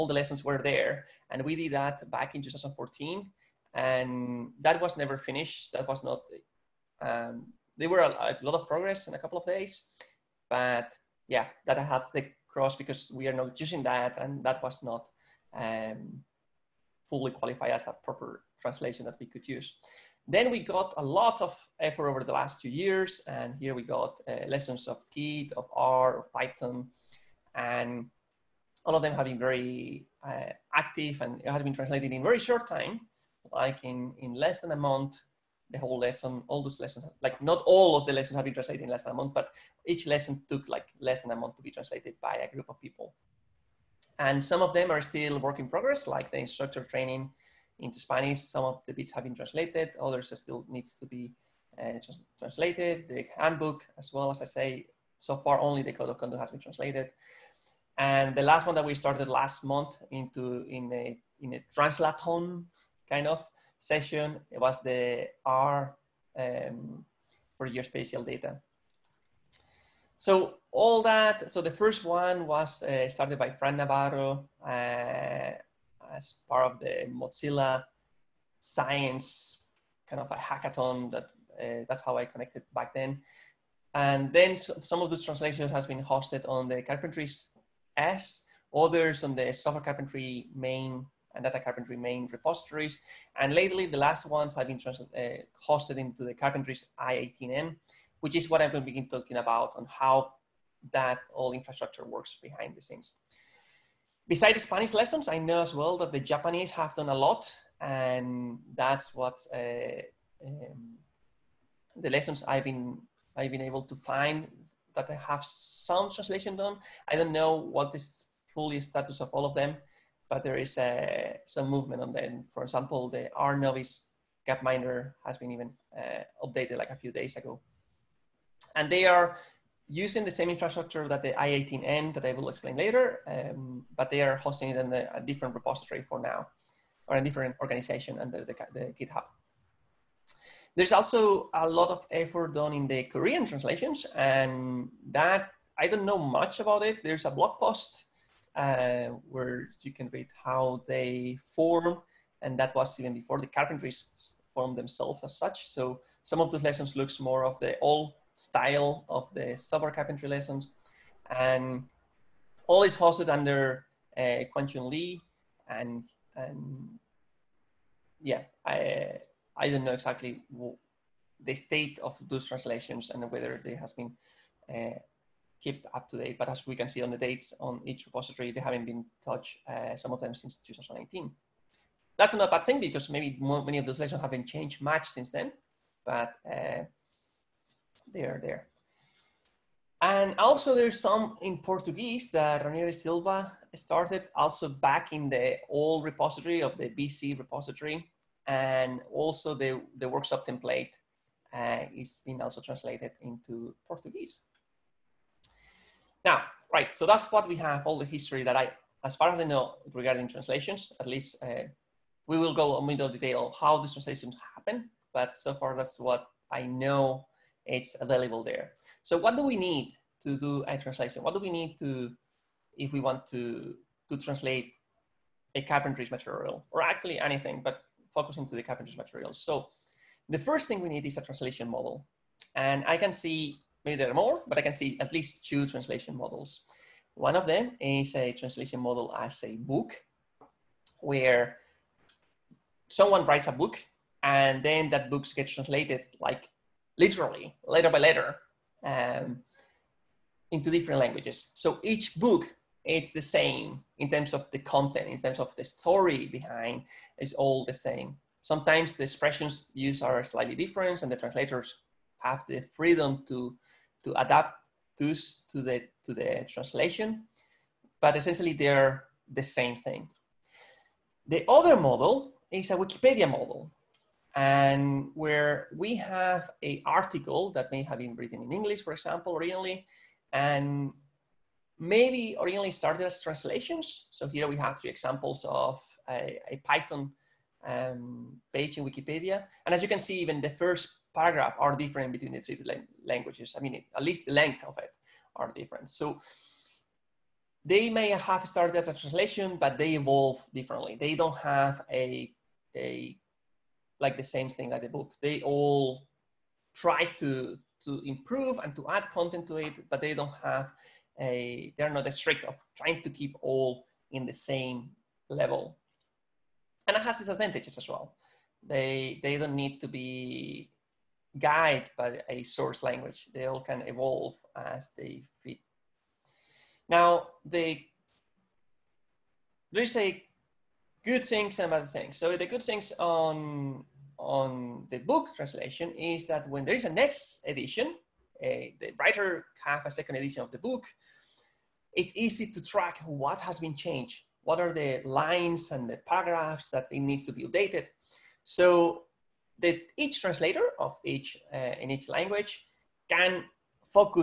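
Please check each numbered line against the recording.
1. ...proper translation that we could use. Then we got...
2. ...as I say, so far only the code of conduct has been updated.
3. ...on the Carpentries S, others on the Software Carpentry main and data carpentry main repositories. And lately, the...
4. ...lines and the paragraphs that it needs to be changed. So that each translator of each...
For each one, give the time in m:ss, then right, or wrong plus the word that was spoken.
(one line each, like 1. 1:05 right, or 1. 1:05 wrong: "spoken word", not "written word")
1. 0:18 right
2. 0:54 wrong: "translated", not "updated"
3. 1:26 right
4. 5:45 wrong: "updated", not "changed".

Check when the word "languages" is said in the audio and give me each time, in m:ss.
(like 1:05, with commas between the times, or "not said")
4:10, 4:53, 5:22, 5:52.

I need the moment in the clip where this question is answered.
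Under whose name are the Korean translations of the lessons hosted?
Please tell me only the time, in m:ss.
2:44.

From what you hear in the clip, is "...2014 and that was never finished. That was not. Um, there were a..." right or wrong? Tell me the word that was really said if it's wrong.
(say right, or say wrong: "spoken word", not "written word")
right.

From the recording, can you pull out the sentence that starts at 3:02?
That's not a bad thing because maybe more, many of those lessons haven't changed much since then, but uh, they are there.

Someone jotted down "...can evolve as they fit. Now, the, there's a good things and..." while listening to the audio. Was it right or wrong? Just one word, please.
right.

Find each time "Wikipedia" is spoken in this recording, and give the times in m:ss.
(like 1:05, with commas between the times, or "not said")
4:32, 4:48.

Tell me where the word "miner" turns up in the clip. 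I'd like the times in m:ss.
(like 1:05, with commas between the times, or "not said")
2:04.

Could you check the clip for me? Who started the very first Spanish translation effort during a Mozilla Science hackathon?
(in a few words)
Fran Navarro.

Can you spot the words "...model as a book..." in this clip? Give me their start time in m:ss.
3:58.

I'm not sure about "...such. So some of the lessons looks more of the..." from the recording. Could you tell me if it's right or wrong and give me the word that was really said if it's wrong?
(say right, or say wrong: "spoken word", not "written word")
right.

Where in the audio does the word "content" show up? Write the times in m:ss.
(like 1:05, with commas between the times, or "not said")
4:14, 5:09.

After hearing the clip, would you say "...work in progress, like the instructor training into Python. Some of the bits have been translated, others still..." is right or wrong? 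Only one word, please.
wrong.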